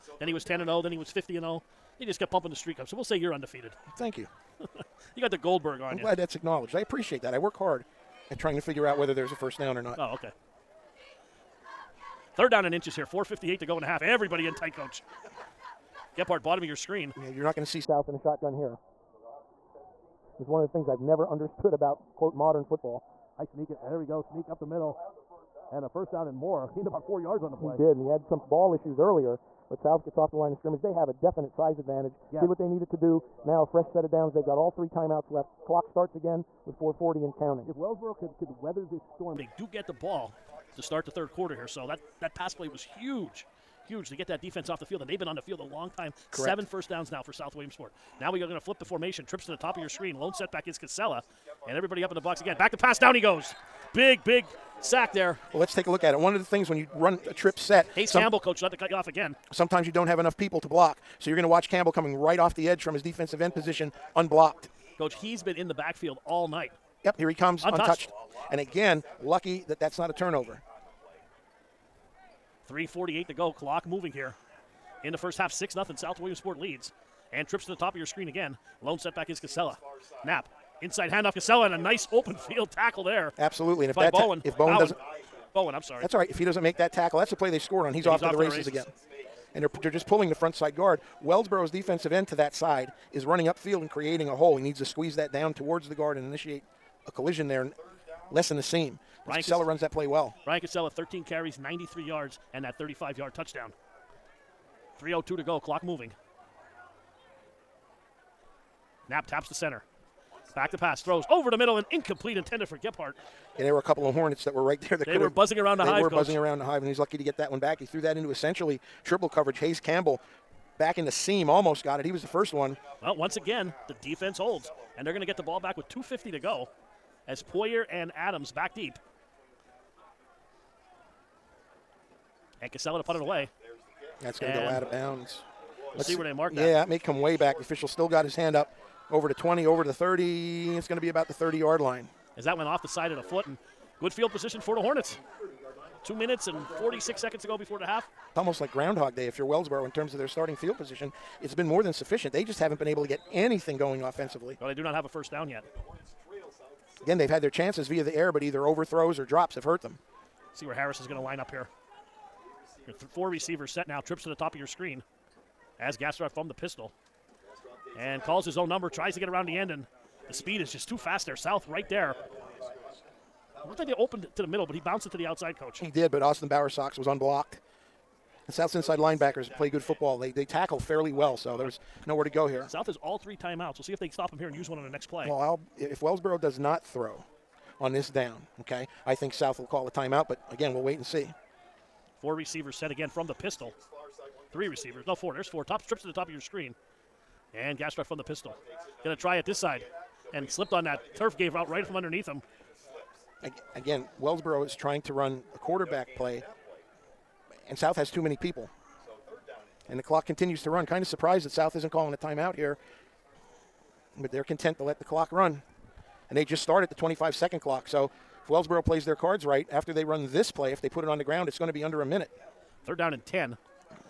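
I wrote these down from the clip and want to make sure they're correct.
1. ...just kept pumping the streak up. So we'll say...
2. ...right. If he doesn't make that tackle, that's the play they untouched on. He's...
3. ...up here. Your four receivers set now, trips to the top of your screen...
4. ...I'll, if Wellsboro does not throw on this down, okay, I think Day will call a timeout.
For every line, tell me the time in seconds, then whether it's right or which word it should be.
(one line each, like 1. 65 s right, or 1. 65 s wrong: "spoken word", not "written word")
1. 2 s right
2. 86 s wrong: "scored", not "untouched"
3. 161 s right
4. 185 s wrong: "South", not "Day".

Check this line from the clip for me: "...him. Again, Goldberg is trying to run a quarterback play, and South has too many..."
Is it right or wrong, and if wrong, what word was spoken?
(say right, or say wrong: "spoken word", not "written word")
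wrong: "Wellsboro", not "Goldberg".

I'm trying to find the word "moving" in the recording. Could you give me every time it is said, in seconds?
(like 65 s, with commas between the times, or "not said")
73 s, 105 s.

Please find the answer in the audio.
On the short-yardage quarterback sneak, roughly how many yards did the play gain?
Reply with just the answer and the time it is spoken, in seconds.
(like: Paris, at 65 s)
4 yards, at 26 s.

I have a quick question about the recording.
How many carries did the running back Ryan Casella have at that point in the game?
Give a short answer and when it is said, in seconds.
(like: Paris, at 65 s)
13, at 100 s.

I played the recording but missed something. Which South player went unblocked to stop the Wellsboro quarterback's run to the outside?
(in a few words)
Austin Bowersox.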